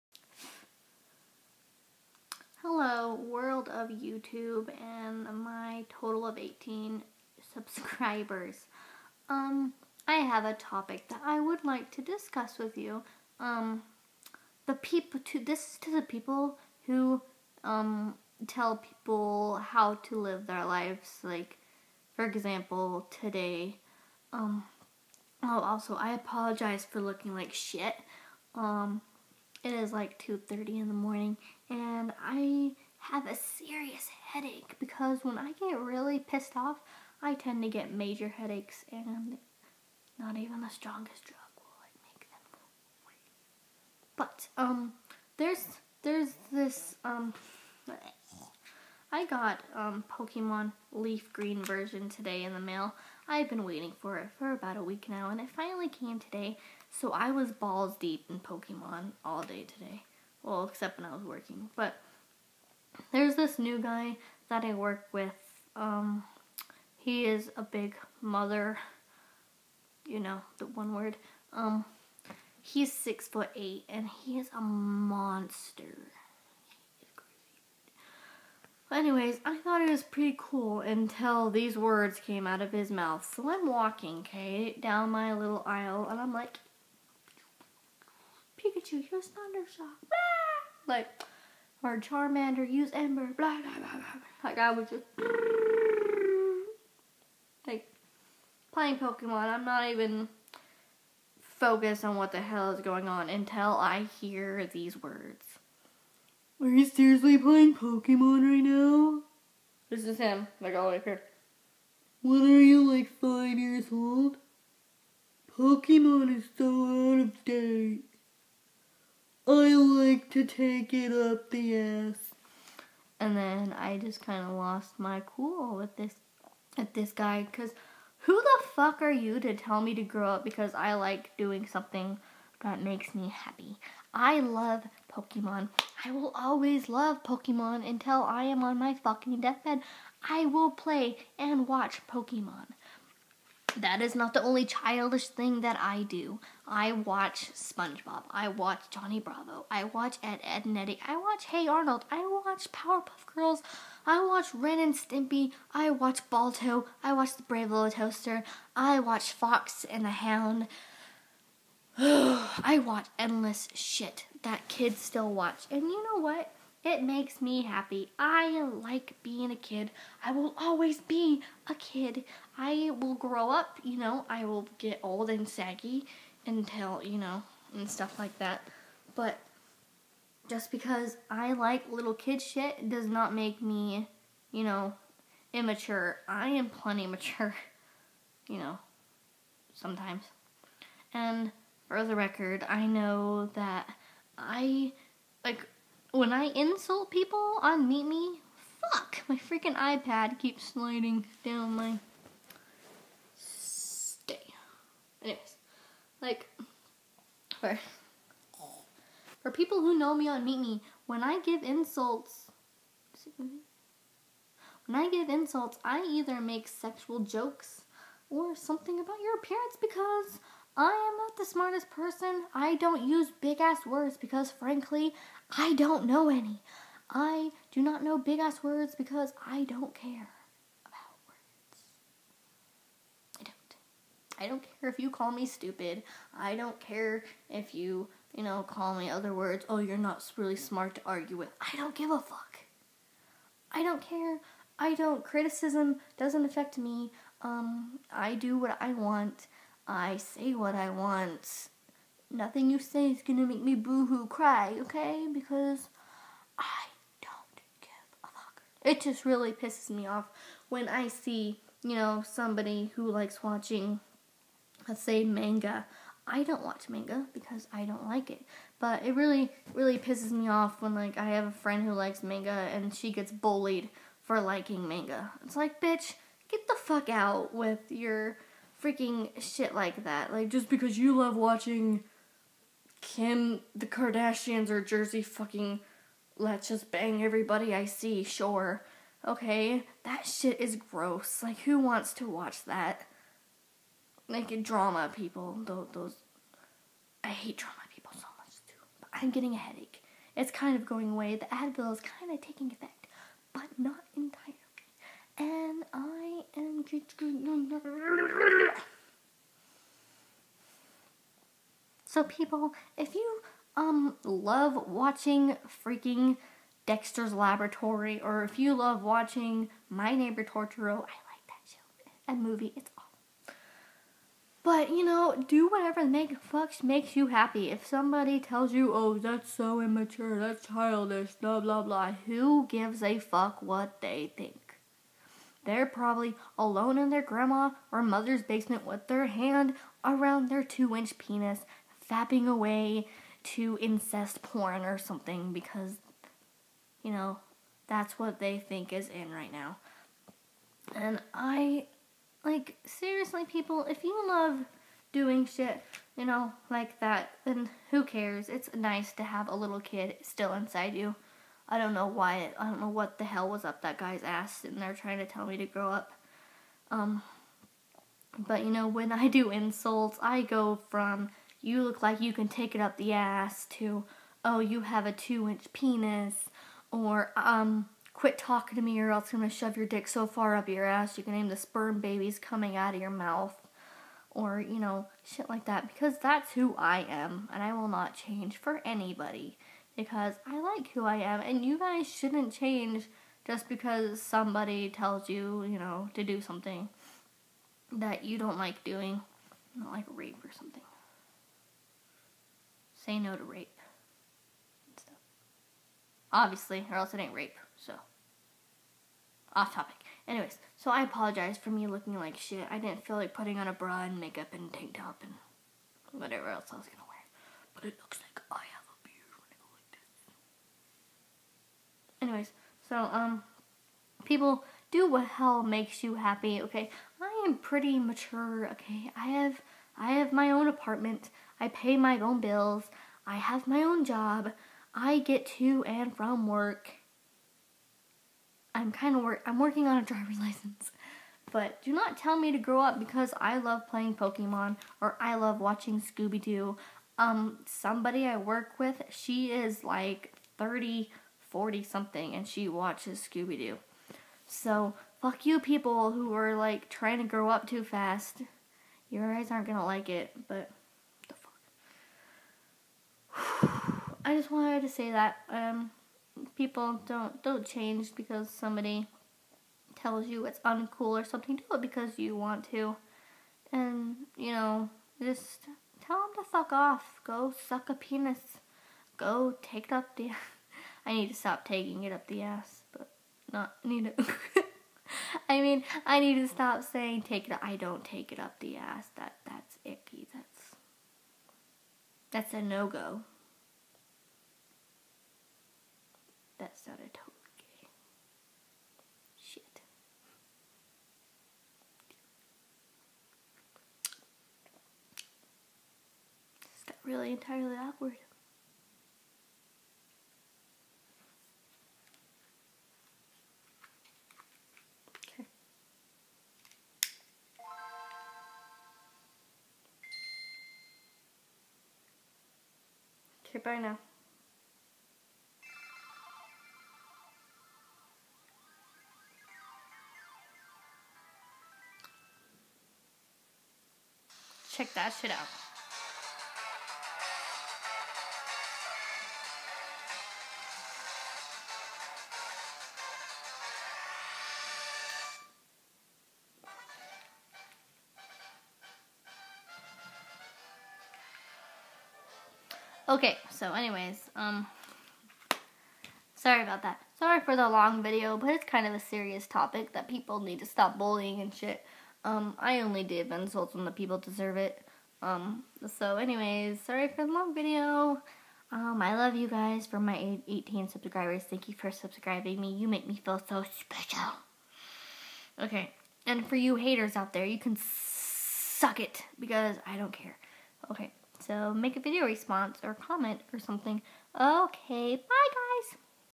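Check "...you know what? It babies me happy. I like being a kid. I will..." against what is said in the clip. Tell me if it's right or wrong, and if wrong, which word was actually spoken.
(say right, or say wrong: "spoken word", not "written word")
wrong: "makes", not "babies".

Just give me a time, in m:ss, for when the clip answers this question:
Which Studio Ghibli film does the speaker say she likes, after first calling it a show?
5:19.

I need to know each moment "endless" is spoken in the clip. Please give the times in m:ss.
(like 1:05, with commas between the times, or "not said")
2:43.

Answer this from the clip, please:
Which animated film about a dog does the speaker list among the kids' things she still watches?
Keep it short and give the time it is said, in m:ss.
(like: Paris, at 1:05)
Balto, at 2:36.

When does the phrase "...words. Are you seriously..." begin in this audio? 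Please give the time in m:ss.
1:45.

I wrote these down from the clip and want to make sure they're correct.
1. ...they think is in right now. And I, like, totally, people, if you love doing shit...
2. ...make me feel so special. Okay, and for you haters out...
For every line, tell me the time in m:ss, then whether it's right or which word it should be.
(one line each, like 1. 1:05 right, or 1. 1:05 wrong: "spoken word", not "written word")
1. 5:48 wrong: "seriously", not "totally"
2. 9:32 right.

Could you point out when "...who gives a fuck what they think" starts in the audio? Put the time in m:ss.
5:32.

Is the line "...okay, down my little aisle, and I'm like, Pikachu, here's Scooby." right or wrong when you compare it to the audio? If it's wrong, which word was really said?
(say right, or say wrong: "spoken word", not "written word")
wrong: "Thundershock", not "Scooby".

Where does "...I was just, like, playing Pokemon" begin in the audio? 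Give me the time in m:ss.
1:34.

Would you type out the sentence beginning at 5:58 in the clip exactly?
It's nice to have a little kid still inside you.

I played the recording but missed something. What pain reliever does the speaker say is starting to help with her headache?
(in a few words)
Advil.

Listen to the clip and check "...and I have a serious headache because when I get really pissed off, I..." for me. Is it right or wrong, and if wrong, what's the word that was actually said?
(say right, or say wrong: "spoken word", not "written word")
right.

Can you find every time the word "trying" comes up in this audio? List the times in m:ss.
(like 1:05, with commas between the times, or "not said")
6:04, 7:36.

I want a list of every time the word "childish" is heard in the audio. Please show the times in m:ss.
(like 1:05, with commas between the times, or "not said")
2:24, 5:30.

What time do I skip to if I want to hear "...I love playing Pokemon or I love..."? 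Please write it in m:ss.
7:23.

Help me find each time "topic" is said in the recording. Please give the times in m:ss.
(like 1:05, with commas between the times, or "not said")
0:10, 6:49, 9:19.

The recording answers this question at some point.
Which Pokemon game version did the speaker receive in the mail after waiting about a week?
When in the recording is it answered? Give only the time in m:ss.
0:50.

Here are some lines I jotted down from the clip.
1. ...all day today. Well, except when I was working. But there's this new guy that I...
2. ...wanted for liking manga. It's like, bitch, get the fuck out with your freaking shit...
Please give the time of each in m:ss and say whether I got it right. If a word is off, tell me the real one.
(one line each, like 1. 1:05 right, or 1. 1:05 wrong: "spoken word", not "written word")
1. 0:59 right
2. 4:33 wrong: "bullied", not "wanted".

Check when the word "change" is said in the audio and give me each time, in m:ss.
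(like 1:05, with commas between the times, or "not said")
6:28, 6:32, 7:47.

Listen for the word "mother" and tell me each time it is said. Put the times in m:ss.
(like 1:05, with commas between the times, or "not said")
1:08, 5:38.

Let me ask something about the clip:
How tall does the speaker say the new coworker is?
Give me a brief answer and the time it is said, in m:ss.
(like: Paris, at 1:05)
six foot eight, at 1:12.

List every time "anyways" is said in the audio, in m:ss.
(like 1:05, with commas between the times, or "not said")
1:18, 3:25, 6:50, 7:02, 9:13, 9:26.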